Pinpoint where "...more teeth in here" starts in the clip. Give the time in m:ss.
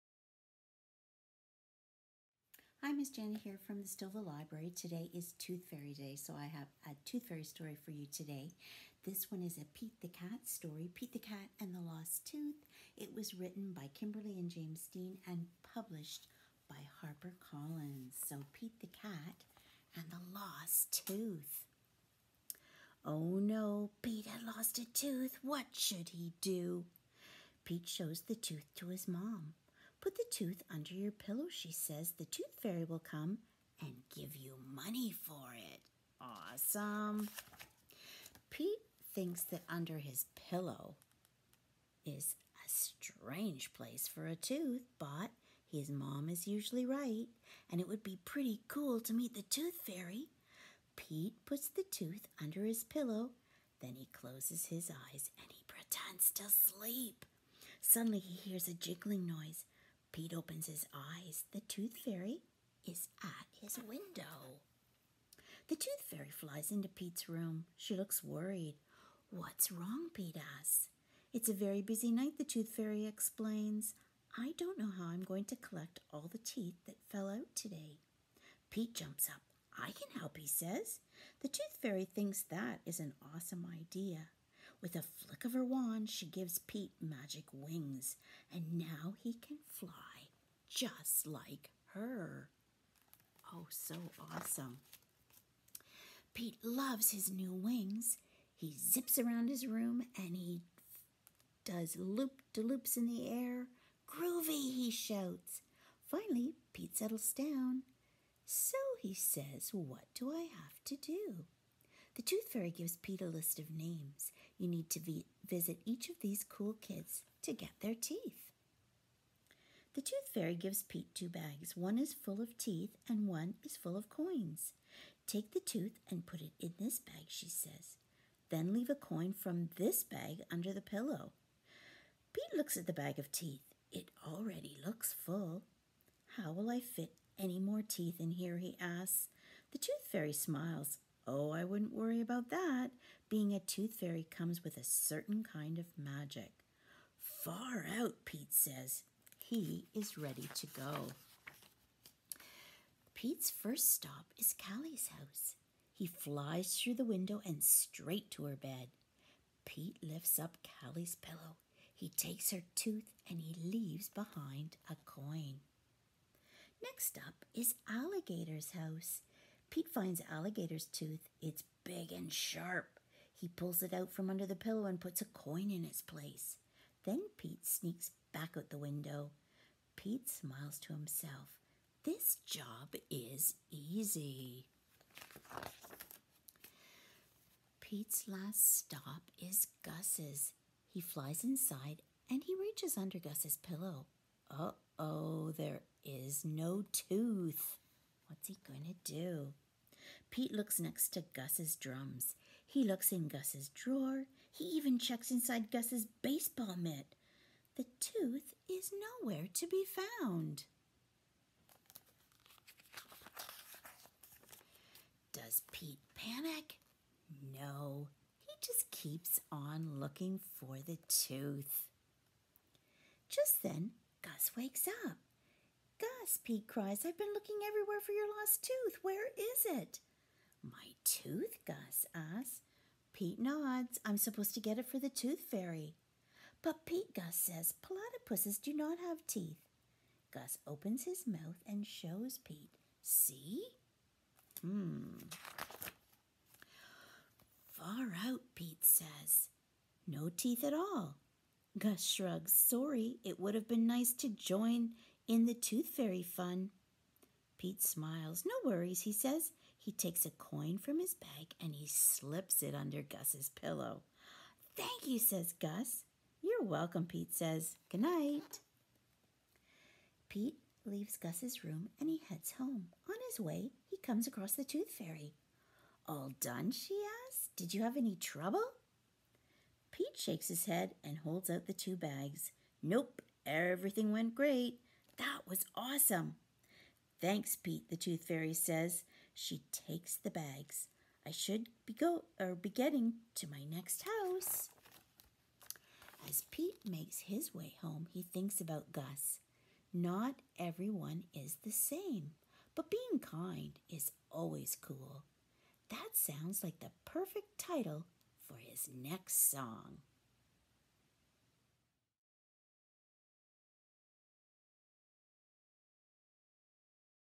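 2:17.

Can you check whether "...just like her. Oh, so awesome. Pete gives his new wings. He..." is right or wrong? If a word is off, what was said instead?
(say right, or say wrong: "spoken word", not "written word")
wrong: "loves", not "gives".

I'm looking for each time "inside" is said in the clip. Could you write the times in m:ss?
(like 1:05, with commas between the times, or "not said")
3:11, 3:25.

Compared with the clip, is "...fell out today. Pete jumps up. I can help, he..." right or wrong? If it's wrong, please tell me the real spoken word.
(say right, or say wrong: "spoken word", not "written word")
right.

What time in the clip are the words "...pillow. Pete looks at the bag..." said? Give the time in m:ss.
2:10.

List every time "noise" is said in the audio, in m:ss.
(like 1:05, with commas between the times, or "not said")
0:59.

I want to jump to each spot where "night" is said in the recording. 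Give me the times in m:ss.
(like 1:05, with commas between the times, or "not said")
1:12, 4:28.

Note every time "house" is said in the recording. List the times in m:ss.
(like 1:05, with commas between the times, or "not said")
2:35, 2:48, 4:54.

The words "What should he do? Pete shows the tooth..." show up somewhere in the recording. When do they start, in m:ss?
0:25.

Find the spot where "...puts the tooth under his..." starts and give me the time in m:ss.
0:51.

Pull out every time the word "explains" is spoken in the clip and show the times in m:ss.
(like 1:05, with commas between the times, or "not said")
1:13.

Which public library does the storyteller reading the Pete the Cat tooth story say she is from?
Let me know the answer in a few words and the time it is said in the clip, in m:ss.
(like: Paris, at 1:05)
Stouffville Library, at 0:03.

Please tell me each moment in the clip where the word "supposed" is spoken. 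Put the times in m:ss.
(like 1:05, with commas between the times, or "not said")
3:54.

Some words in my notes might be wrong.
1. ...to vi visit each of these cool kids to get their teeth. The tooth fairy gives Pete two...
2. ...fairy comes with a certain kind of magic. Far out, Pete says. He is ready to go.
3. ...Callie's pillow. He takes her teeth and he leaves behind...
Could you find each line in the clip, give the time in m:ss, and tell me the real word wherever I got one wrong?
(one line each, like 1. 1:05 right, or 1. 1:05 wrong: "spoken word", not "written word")
1. 1:54 right
2. 2:23 right
3. 2:40 wrong: "tooth", not "teeth".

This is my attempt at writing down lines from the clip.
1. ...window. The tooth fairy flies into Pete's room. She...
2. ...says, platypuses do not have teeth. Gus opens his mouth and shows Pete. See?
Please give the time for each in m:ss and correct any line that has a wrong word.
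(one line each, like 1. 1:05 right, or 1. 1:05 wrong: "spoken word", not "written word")
1. 1:03 right
2. 3:57 right.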